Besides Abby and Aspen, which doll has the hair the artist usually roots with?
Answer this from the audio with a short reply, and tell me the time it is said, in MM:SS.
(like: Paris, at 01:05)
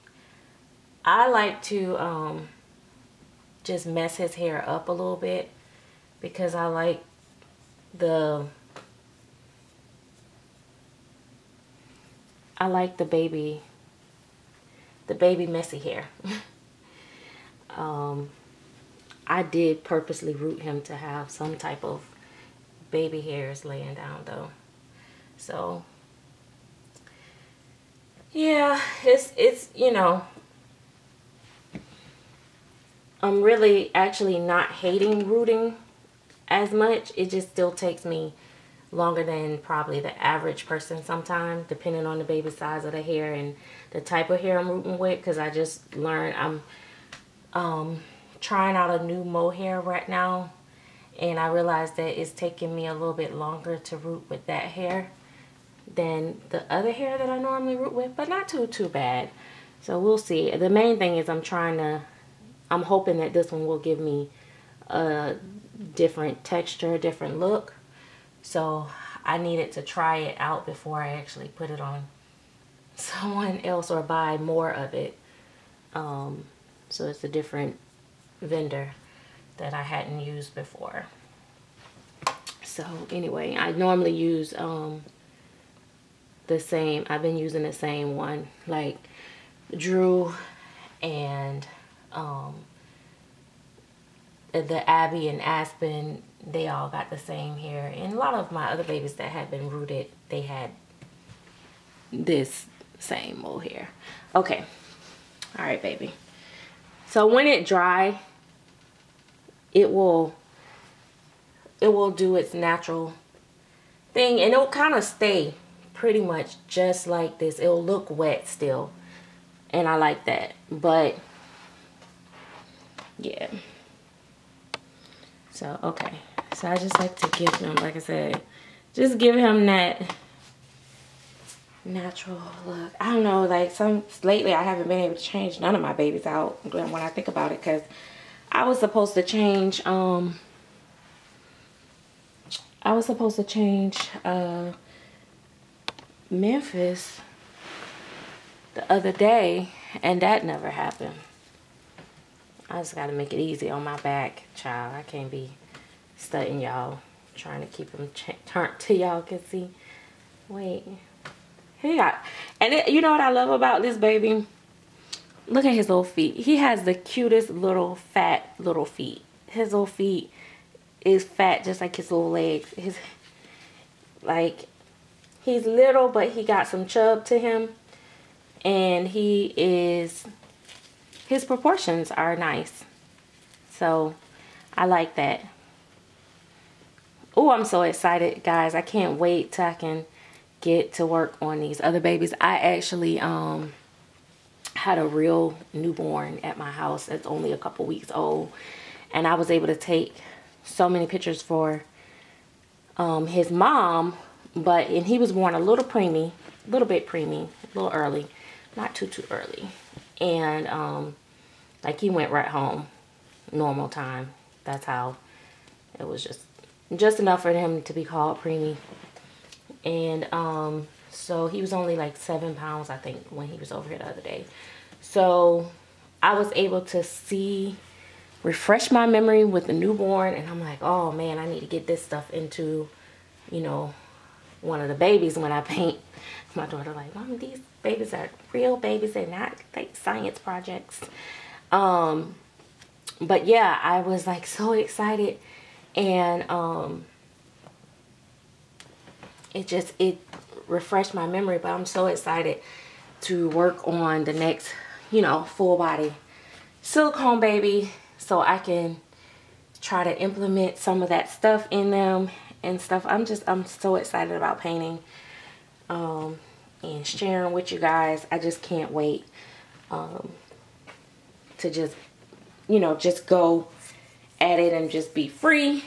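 Drew, at 01:29.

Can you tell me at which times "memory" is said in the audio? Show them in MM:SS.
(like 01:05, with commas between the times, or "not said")
03:49, 04:11.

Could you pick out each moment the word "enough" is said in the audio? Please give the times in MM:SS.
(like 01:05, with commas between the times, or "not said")
03:37.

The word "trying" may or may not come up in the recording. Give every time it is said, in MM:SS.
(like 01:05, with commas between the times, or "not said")
00:48, 01:01, 02:37.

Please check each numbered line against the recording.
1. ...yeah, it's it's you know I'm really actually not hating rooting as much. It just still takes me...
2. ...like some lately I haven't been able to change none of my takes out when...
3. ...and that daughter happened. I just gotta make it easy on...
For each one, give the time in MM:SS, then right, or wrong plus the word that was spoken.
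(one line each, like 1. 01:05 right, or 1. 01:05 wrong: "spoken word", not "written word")
1. 00:28 right
2. 02:13 wrong: "babies", not "takes"
3. 02:30 wrong: "never", not "daughter".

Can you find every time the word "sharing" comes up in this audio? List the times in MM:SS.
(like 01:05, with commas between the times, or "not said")
04:27.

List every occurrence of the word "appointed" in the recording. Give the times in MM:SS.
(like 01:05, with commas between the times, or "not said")
not said.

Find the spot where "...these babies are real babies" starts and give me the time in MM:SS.
03:57.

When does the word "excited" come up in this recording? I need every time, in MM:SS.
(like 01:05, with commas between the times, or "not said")
03:07, 04:04, 04:12, 04:23.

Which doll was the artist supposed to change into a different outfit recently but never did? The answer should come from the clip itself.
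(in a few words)
Memphis.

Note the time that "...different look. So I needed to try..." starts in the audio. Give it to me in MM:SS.
01:06.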